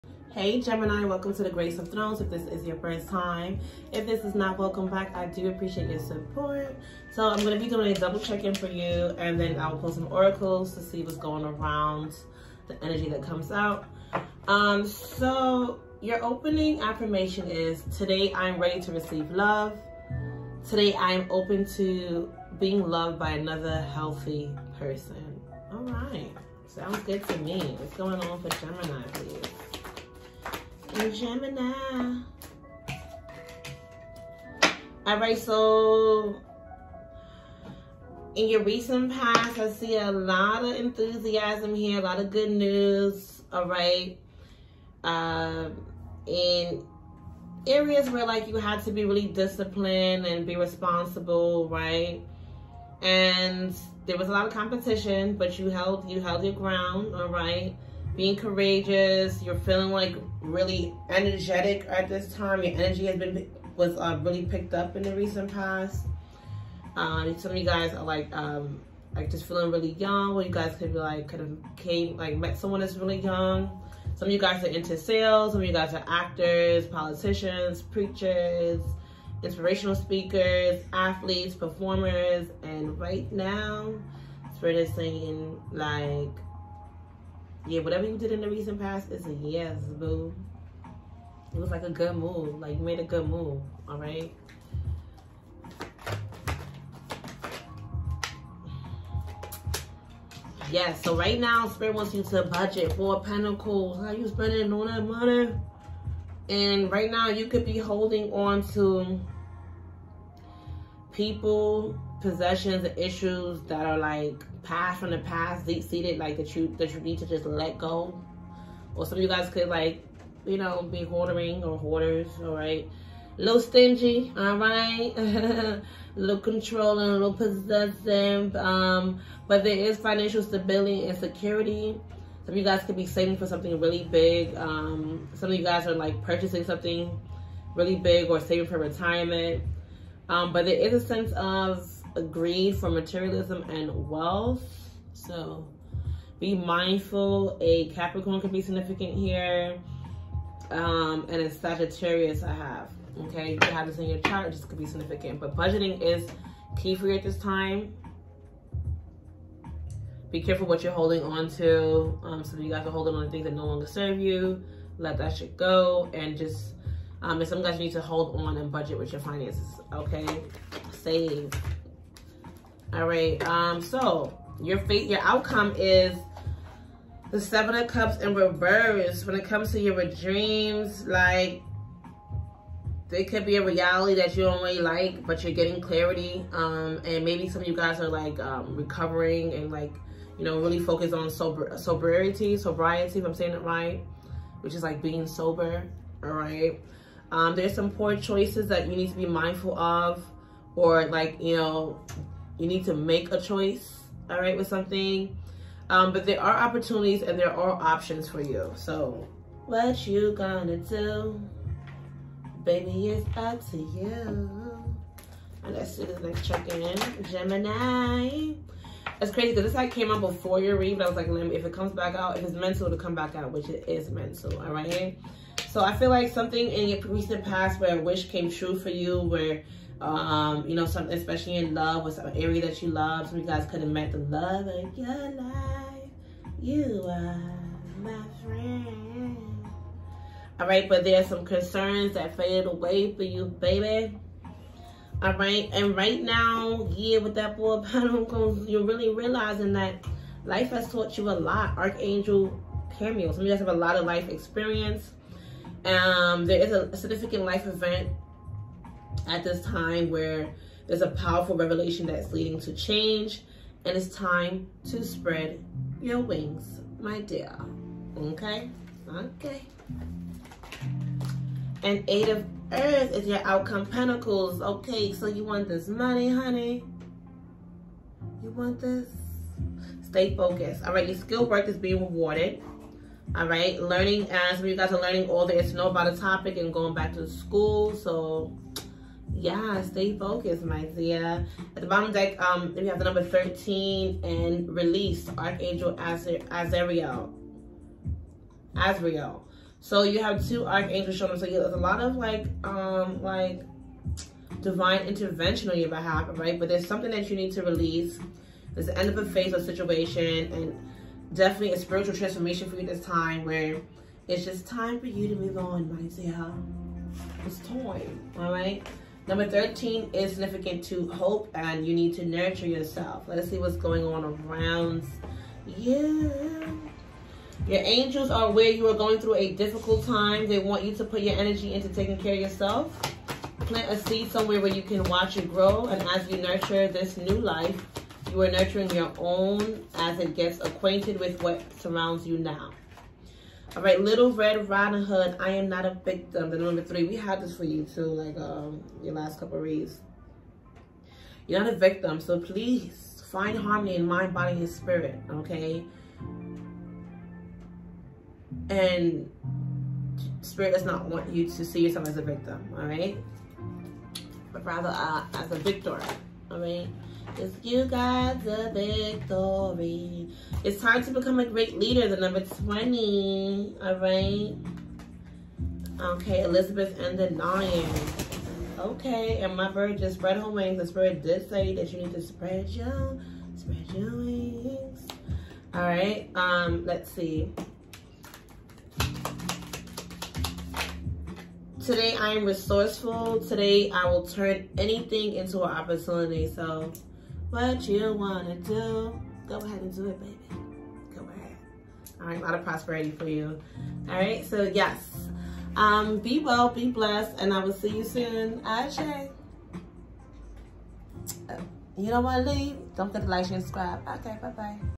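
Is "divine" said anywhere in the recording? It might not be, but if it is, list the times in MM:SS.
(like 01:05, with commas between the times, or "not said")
05:04.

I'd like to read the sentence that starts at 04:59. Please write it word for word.
So you have two archangels showing up.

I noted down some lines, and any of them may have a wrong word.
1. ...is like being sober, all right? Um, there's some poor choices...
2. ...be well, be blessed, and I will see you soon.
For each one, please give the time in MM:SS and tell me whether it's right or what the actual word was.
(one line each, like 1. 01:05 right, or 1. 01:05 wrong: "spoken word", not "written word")
1. 03:14 right
2. 06:46 right.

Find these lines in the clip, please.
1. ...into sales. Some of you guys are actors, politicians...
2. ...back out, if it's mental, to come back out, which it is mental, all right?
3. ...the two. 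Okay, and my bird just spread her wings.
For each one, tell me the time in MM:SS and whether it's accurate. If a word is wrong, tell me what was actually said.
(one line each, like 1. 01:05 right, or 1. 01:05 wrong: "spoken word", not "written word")
1. 01:14 right
2. 03:41 right
3. 06:17 wrong: "nine", not "two".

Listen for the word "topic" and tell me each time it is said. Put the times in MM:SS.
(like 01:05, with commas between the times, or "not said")
04:46.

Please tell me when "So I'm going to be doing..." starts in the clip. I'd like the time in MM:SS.
00:07.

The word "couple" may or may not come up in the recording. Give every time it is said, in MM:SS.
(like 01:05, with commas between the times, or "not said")
05:49.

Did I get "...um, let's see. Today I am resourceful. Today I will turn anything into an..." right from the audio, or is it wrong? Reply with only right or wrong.
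right.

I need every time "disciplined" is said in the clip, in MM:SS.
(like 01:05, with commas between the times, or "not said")
00:49.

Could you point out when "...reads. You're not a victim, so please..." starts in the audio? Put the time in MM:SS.
05:49.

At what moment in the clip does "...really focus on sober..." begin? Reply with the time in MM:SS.
03:10.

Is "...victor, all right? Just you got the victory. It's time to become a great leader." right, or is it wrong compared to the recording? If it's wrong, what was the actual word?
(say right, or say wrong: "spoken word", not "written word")
right.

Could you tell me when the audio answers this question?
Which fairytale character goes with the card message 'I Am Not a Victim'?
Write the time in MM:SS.
05:44.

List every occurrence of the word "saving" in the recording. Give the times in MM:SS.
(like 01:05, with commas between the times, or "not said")
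02:13, 02:18.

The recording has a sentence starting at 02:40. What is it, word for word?
Be careful what you're holding on to.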